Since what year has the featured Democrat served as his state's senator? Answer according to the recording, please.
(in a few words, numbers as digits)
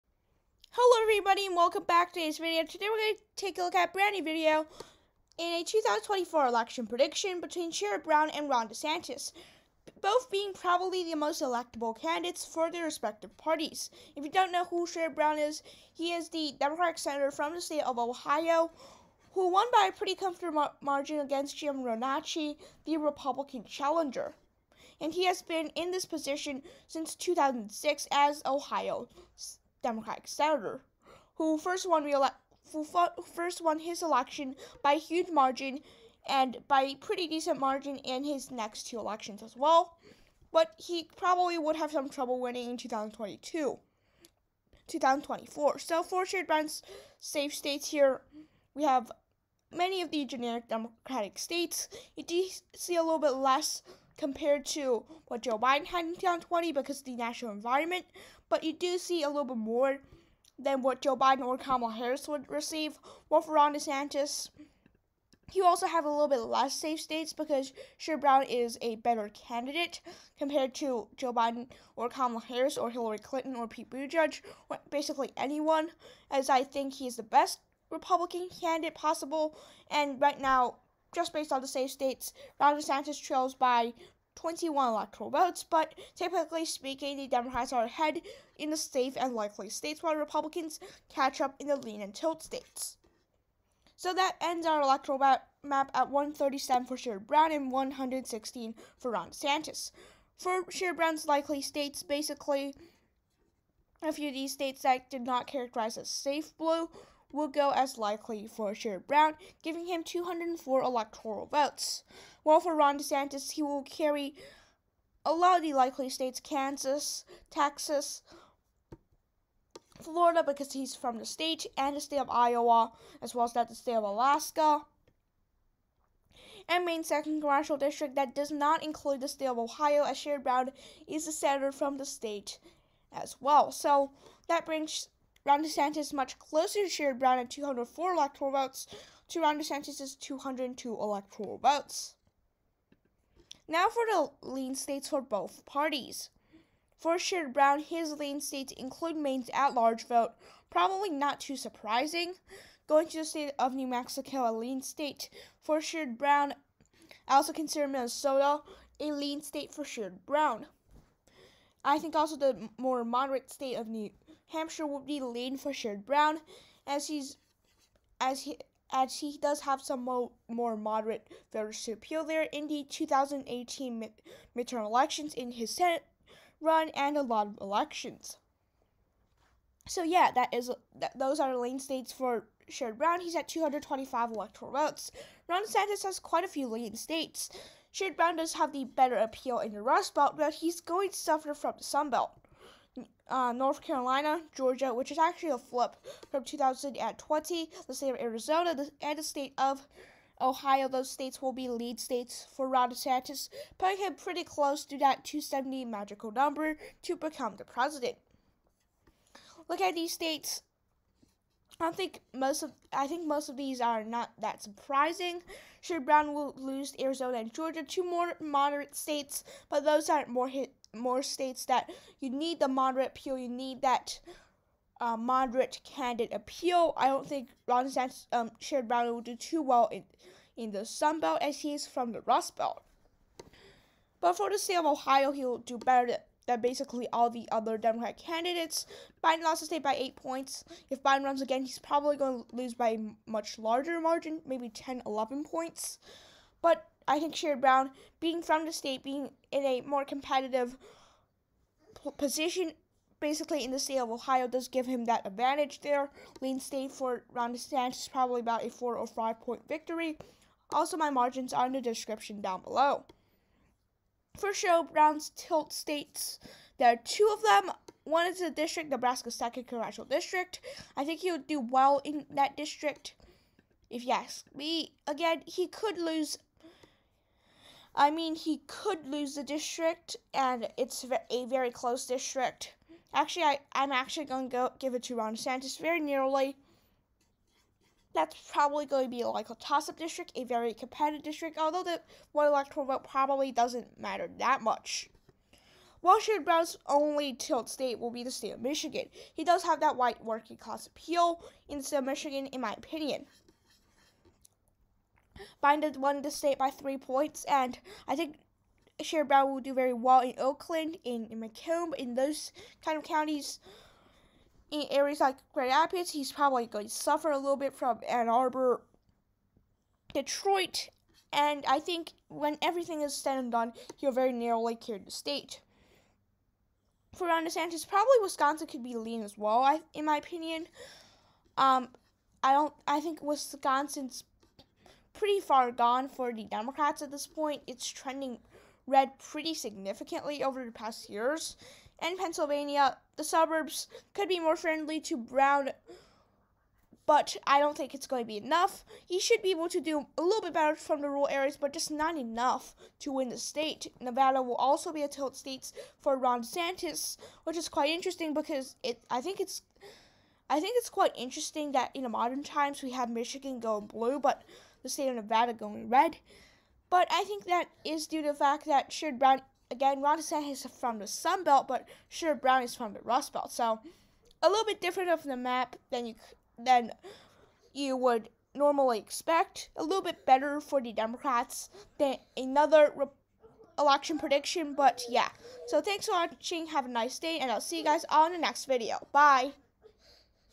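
2006.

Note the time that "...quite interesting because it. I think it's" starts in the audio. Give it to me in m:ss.
5:57.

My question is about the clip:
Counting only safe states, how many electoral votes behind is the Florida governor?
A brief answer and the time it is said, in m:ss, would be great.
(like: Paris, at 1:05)
21, at 1:24.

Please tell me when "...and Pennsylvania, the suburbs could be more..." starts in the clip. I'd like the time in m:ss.
5:42.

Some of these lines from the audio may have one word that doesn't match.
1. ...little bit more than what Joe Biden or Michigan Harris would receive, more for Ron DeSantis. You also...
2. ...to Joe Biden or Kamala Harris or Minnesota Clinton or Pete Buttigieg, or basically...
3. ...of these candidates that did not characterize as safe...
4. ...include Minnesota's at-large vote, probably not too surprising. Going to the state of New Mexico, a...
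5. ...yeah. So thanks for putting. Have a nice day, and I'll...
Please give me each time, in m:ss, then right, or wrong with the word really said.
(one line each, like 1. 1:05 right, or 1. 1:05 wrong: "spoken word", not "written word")
1. 0:59 wrong: "Kamala", not "Michigan"
2. 1:10 wrong: "Hillary", not "Minnesota"
3. 1:44 wrong: "states", not "candidates"
4. 2:28 wrong: "Maine", not "Minnesota"
5. 6:25 wrong: "watching", not "putting".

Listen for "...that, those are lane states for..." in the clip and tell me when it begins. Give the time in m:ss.
3:00.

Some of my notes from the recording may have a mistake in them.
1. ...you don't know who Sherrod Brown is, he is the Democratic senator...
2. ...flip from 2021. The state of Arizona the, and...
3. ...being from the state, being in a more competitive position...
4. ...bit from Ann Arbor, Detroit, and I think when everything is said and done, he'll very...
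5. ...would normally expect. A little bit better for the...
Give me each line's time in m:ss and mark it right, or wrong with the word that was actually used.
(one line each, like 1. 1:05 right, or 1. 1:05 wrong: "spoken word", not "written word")
1. 0:14 right
2. 3:15 wrong: "2020", not "2021"
3. 4:08 right
4. 5:17 right
5. 6:17 right.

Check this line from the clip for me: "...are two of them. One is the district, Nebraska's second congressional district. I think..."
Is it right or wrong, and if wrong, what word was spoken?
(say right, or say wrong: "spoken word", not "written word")
right.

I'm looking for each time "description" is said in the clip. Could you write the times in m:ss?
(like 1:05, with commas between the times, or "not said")
4:21.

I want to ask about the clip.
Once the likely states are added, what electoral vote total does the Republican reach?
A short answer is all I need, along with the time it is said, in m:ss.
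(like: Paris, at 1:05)
202, at 2:20.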